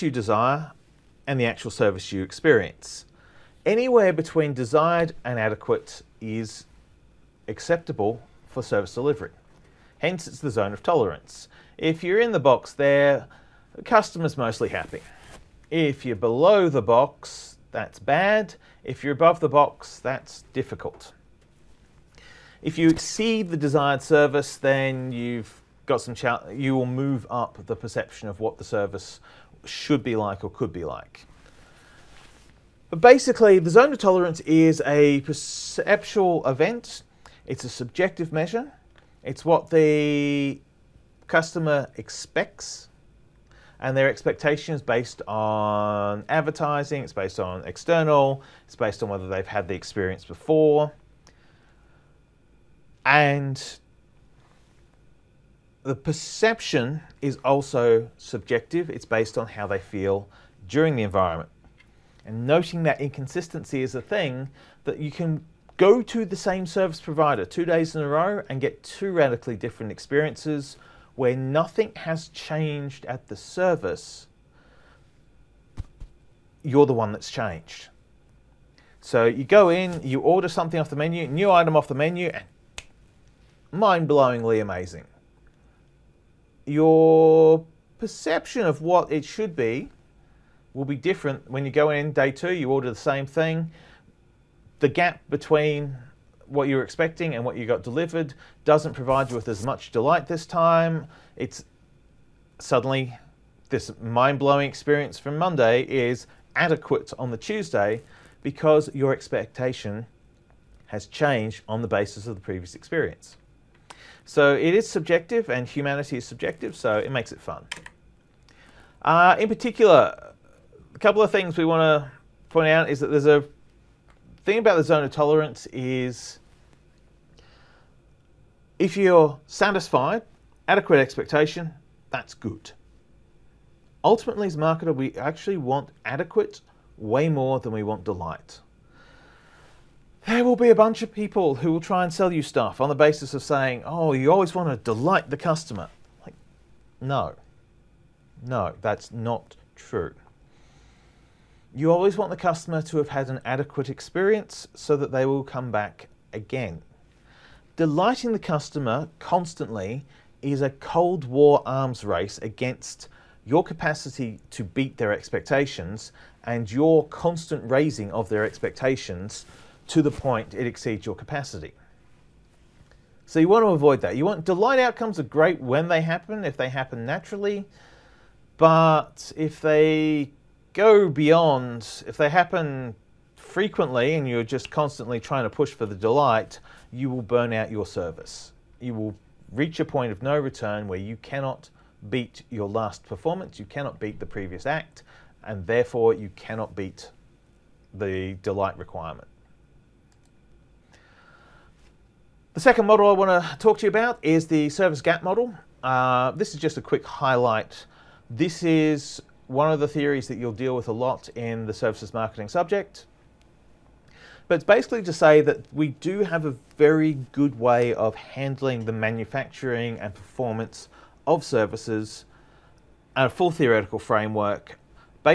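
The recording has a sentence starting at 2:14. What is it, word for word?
Ultimately, as marketer, we actually want adequate way more than we want delight.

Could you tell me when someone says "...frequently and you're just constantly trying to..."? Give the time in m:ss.
3:03.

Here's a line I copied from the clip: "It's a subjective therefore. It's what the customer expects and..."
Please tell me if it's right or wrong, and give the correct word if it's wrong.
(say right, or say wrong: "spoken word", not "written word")
wrong: "measure", not "therefore".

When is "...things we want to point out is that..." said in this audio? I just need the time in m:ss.
2:01.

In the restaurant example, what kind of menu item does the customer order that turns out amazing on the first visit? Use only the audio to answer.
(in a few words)
New item.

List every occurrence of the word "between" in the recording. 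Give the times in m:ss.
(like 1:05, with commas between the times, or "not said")
0:04, 1:35.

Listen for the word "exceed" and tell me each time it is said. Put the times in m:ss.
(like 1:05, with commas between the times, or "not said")
0:22, 2:50.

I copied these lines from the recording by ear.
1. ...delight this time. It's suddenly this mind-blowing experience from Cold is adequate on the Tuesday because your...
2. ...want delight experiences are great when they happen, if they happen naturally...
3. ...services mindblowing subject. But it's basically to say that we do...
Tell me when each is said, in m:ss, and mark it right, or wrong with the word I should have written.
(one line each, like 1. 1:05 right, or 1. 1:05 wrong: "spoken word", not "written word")
1. 1:39 wrong: "Monday", not "Cold"
2. 2:54 wrong: "outcomes", not "experiences"
3. 3:31 wrong: "marketing", not "mindblowing".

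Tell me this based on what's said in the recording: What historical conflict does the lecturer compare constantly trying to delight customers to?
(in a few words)
Cold War arms race.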